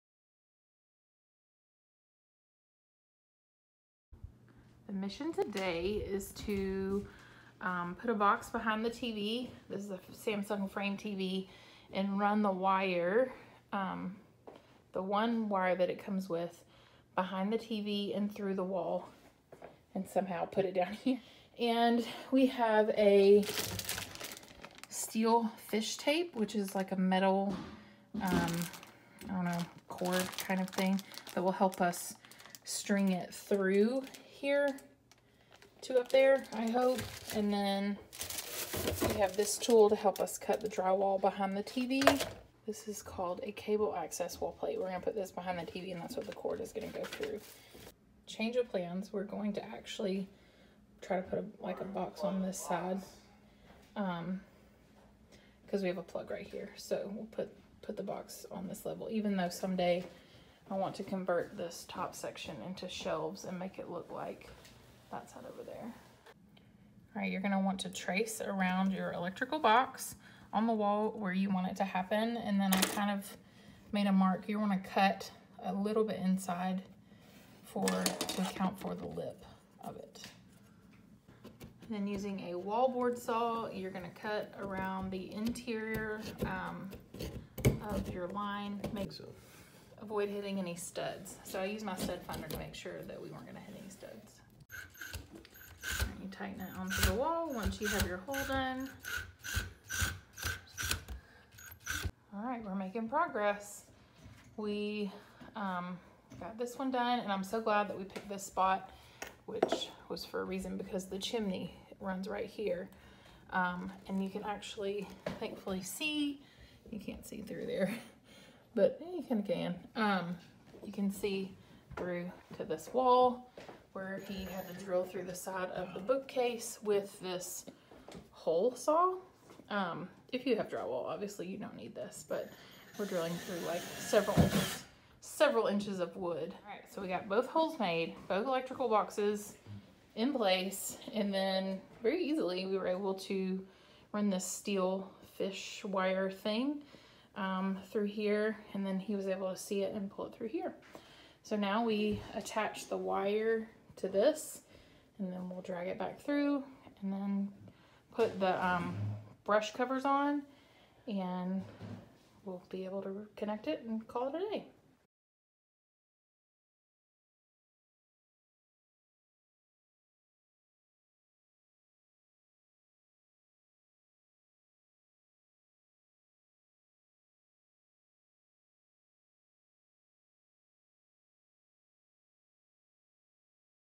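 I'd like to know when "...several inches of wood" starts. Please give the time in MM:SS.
02:15.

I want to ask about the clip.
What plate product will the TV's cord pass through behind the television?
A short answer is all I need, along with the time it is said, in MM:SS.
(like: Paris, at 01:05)
cable access wall plate, at 00:43.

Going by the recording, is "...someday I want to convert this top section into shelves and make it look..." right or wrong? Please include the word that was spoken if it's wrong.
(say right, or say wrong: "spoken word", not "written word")
right.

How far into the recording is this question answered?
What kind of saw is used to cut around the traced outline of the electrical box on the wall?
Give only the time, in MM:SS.
01:22.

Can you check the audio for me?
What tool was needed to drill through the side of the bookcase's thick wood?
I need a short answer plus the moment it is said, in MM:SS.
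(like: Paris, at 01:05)
hole saw, at 02:08.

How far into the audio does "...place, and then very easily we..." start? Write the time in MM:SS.
02:20.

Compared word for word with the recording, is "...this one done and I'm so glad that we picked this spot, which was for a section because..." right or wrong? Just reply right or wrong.
wrong.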